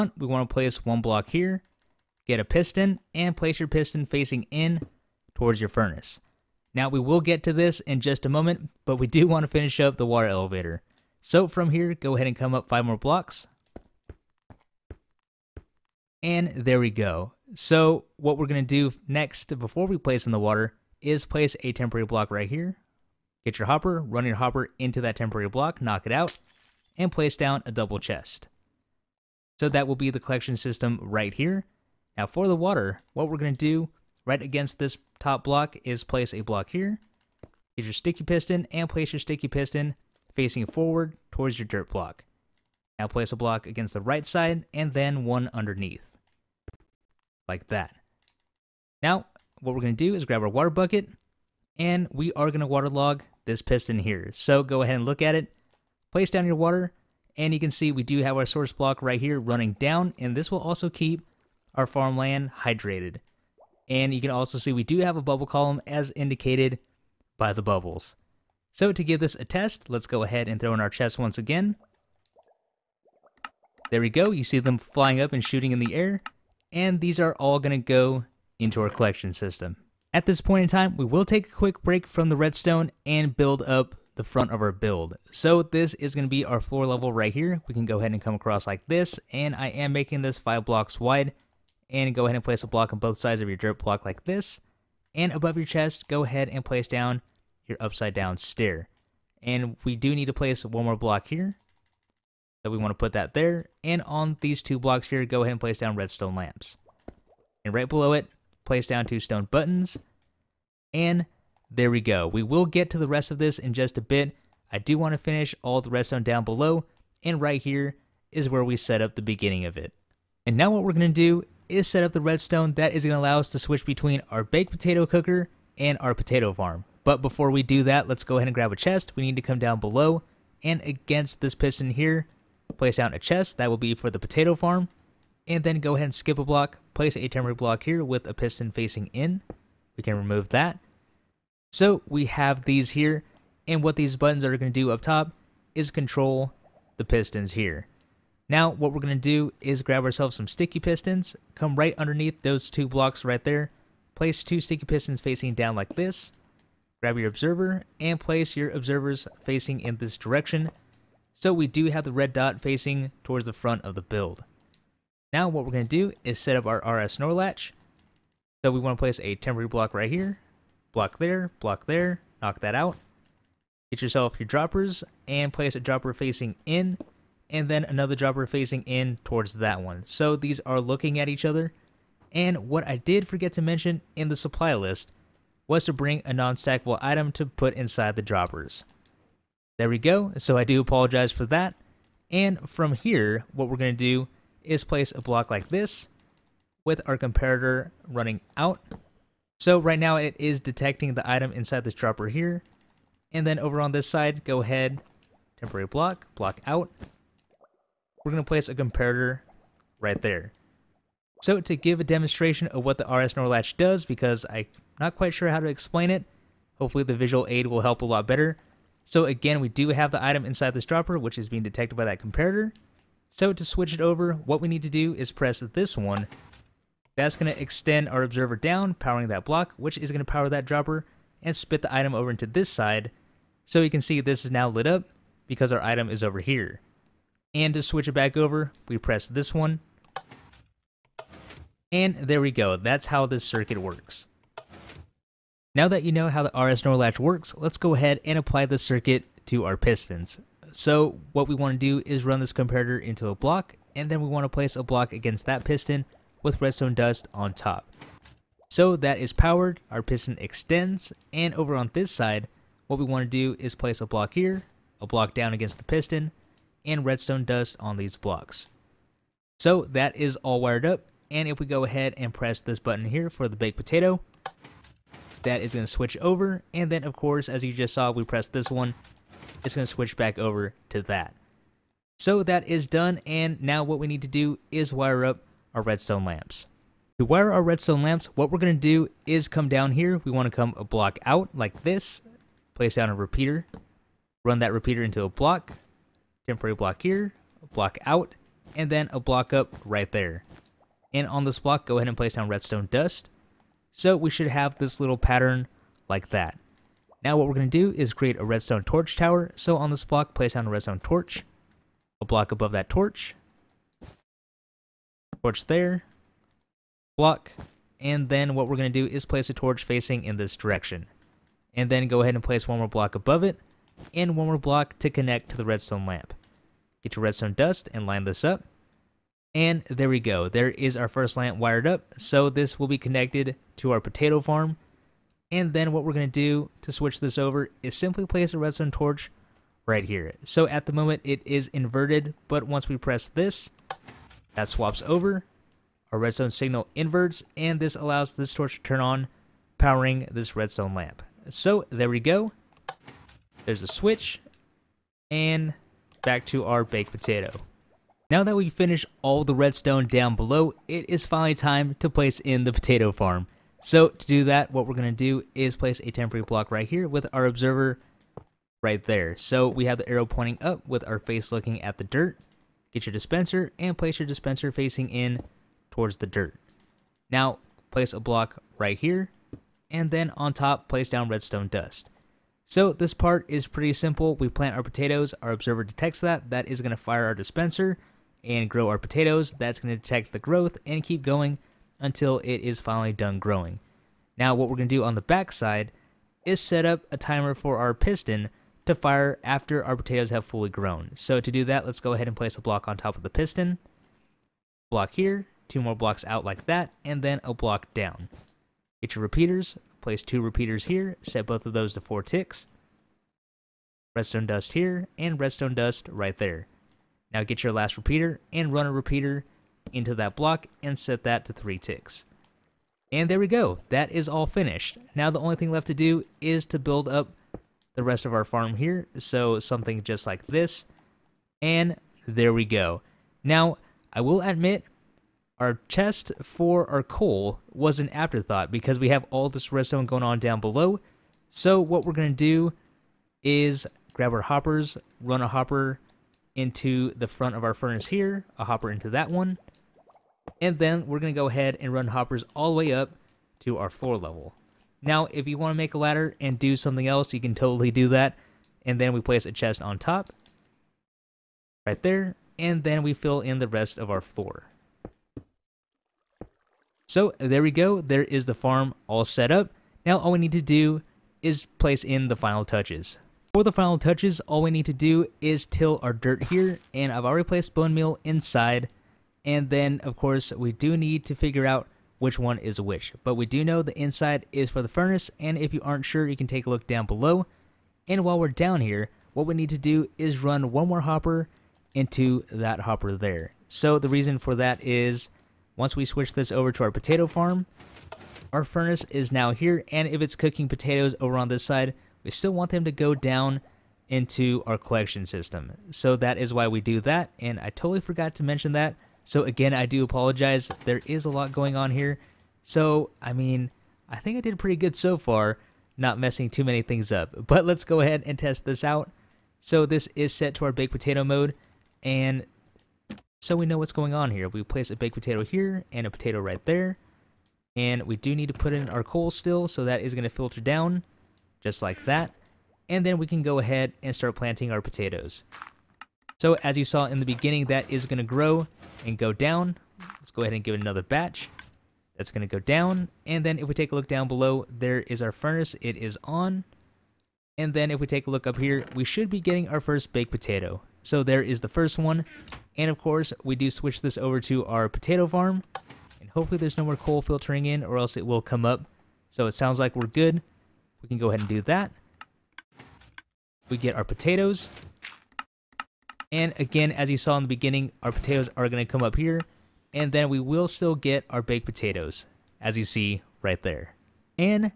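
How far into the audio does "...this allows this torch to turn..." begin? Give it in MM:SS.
05:47.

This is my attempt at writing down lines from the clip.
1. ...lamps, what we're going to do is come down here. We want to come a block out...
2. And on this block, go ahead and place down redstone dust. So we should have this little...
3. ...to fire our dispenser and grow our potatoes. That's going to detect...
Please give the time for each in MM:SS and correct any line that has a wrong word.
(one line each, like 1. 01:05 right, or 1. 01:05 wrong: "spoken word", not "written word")
1. 04:48 right
2. 05:01 right
3. 06:26 right.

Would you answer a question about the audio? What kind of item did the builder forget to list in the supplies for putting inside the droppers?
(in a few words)
Non-stackable item.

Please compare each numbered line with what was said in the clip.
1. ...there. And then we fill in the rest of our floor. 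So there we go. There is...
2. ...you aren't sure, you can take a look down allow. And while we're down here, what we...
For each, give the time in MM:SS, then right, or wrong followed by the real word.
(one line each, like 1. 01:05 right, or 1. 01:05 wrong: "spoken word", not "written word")
1. 07:42 right
2. 08:05 wrong: "below", not "allow".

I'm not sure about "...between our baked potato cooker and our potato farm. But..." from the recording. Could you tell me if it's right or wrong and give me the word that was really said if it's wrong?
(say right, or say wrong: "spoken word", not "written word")
right.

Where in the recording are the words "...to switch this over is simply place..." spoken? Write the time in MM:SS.
05:36.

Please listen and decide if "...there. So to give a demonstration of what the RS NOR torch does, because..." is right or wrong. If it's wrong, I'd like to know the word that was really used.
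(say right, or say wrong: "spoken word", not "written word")
wrong: "latch", not "torch".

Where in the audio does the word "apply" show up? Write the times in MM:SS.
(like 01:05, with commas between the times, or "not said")
04:08.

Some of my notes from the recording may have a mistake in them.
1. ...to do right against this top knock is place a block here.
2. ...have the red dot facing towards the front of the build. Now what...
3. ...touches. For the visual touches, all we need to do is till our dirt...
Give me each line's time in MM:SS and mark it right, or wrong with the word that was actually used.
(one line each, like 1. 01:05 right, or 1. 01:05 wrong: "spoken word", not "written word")
1. 00:33 wrong: "block", not "knock"
2. 02:41 right
3. 07:52 wrong: "final", not "visual".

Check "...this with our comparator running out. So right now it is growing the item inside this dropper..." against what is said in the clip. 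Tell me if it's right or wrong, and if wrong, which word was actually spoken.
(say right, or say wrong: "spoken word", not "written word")
wrong: "detecting", not "growing".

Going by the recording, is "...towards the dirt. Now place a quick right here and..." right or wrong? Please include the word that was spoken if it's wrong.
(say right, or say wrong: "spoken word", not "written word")
wrong: "block", not "quick".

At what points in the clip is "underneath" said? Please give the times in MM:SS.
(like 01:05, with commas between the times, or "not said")
00:45, 02:31.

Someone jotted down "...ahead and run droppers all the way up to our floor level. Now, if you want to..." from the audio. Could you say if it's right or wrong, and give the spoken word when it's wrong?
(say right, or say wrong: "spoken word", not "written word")
wrong: "hoppers", not "droppers".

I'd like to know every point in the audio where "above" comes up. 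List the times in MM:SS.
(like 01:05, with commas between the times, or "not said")
01:35, 05:12, 05:23.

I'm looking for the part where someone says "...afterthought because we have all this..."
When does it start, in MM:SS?
07:18.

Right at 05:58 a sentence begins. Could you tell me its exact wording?
Now that we finished all the redstone down below, it is finally time to place in the potato farm.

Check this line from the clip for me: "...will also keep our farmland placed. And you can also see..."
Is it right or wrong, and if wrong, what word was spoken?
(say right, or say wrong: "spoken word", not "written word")
wrong: "hydrated", not "placed".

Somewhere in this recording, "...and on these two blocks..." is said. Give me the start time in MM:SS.
01:43.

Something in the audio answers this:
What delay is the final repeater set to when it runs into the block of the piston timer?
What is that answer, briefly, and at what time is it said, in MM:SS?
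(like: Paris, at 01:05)
3 ticks, at 07:01.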